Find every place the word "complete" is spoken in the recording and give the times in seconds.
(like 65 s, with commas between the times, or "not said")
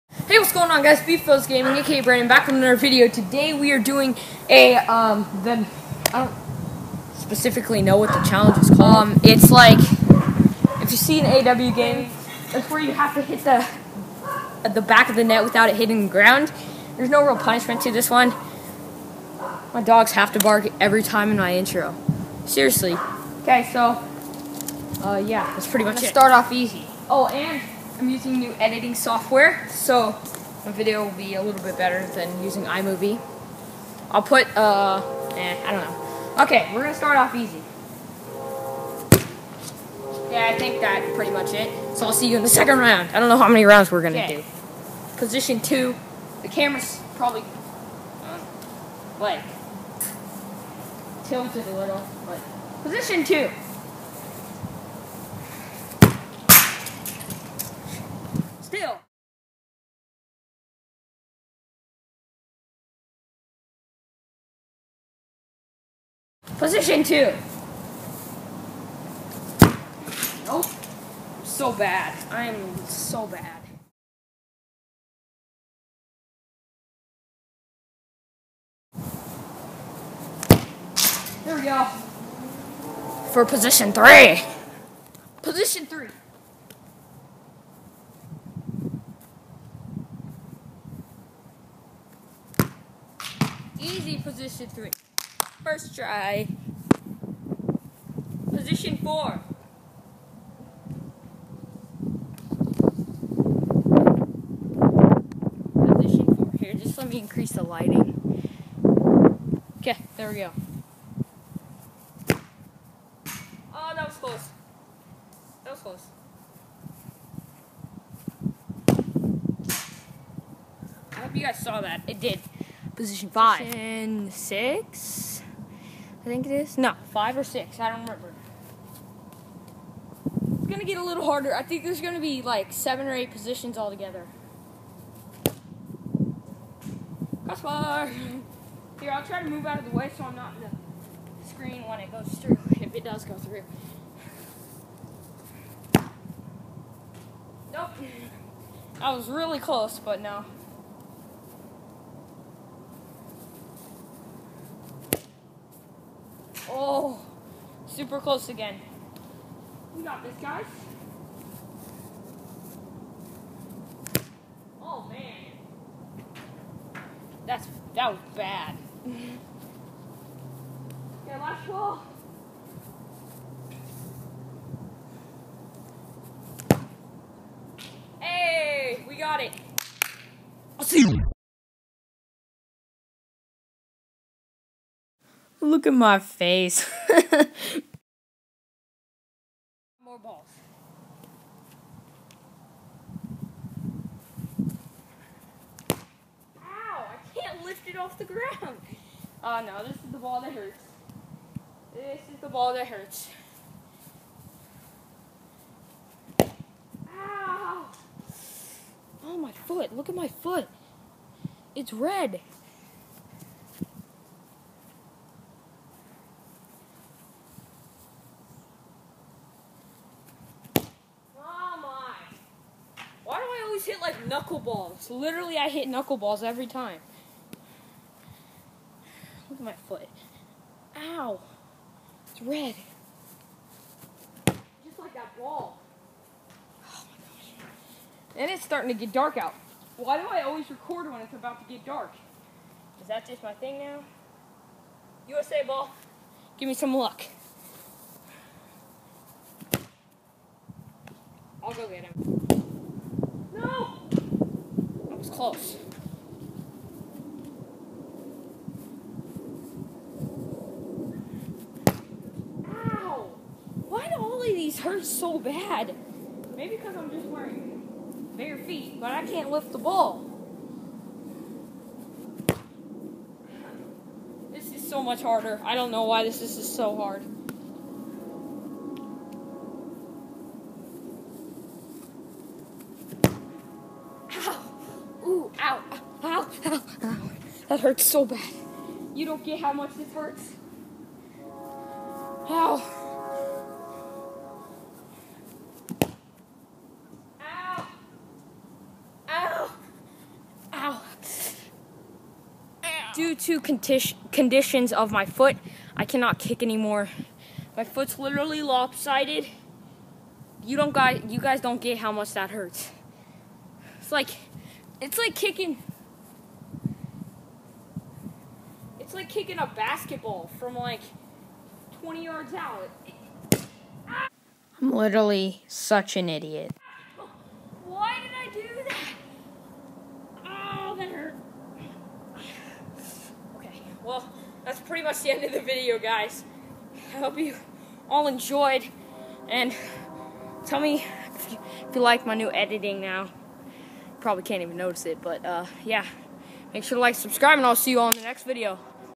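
not said.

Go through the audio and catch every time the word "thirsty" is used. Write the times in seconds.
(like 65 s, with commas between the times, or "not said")
not said.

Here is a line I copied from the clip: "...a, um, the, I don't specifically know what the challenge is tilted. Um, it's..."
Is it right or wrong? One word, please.
wrong.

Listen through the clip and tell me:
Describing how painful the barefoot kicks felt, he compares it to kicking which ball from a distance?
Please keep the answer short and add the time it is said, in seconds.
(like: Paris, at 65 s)
Basketball, at 319 s.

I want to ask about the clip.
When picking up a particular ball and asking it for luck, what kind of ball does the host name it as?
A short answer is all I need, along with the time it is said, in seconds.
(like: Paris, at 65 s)
USA ball, at 245 s.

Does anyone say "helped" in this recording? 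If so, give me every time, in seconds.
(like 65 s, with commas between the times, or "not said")
not said.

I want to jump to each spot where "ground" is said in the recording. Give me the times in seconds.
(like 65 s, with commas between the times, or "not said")
16 s, 198 s.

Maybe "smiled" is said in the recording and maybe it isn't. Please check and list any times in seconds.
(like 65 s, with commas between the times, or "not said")
not said.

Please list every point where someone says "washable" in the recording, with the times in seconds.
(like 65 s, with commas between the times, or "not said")
not said.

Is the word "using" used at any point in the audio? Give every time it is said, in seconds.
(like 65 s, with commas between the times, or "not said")
28 s, 32 s.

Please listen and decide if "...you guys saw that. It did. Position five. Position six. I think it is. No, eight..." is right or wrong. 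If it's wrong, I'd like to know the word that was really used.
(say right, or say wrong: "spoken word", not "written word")
wrong: "five", not "eight".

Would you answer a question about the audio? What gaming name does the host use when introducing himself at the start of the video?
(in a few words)
Beef Gaming.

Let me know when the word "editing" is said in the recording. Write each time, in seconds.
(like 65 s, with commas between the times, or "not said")
28 s, 342 s.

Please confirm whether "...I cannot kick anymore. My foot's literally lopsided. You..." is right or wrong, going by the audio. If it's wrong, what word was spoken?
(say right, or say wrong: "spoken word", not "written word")
right.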